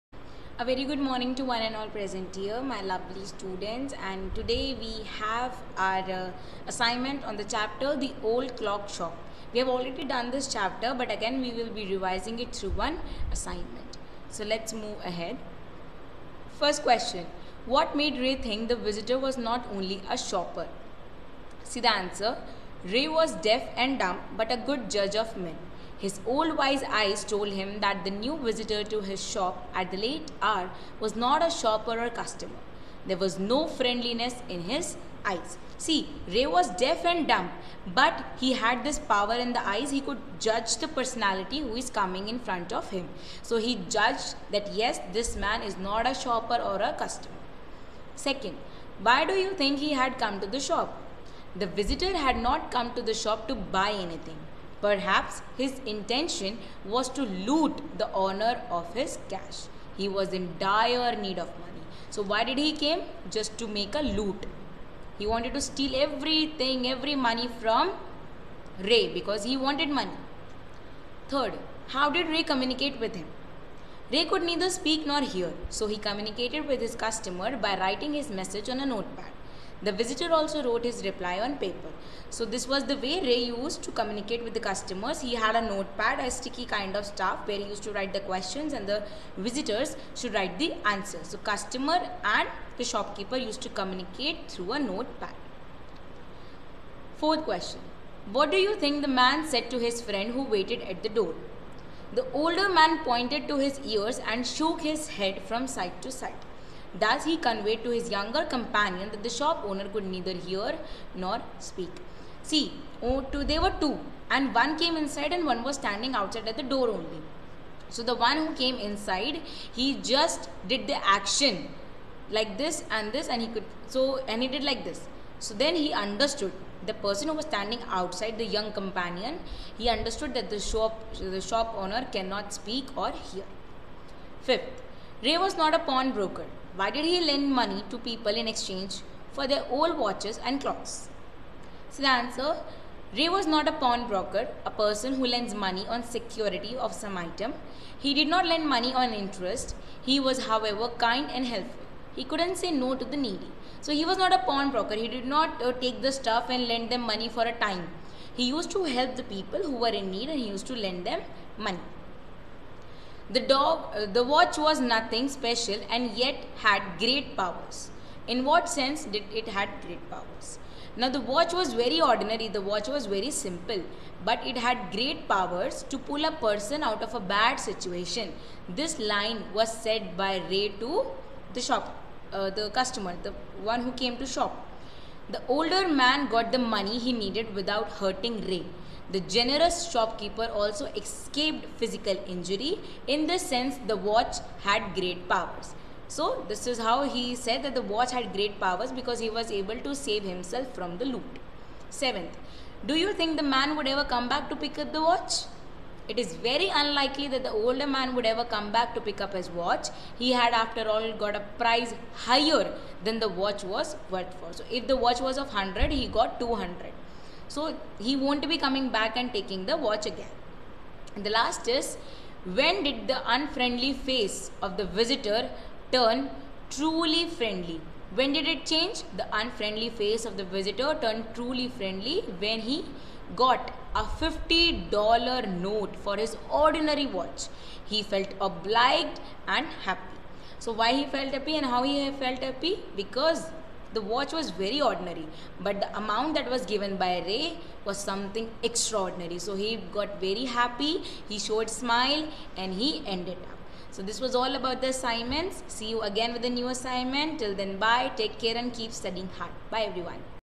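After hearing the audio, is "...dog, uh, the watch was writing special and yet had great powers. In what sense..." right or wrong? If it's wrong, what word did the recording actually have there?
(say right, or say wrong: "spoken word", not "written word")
wrong: "nothing", not "writing".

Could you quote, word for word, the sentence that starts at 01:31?
So customer and the shopkeeper used to communicate through a notepad.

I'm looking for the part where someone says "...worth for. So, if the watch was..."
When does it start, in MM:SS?
03:34.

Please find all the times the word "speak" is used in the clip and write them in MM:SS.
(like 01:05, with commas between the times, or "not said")
01:14, 01:51, 02:12.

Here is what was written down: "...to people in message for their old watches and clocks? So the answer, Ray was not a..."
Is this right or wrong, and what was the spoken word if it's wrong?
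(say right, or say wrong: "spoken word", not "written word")
wrong: "exchange", not "message".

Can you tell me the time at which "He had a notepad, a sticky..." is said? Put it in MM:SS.
01:25.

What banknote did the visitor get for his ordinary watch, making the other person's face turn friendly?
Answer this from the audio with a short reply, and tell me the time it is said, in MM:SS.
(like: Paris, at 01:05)
$50 note, at 03:54.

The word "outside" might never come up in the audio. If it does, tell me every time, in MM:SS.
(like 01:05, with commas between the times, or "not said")
01:56, 02:07.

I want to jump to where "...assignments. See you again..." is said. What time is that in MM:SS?
04:14.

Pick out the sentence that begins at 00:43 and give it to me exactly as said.
So he judged that yes, this man is not a shopper or a customer.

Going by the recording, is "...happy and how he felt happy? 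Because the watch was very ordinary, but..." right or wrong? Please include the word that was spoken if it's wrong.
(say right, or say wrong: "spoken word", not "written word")
right.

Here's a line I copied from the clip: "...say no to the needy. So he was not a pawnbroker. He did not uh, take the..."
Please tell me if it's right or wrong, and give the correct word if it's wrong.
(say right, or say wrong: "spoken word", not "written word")
right.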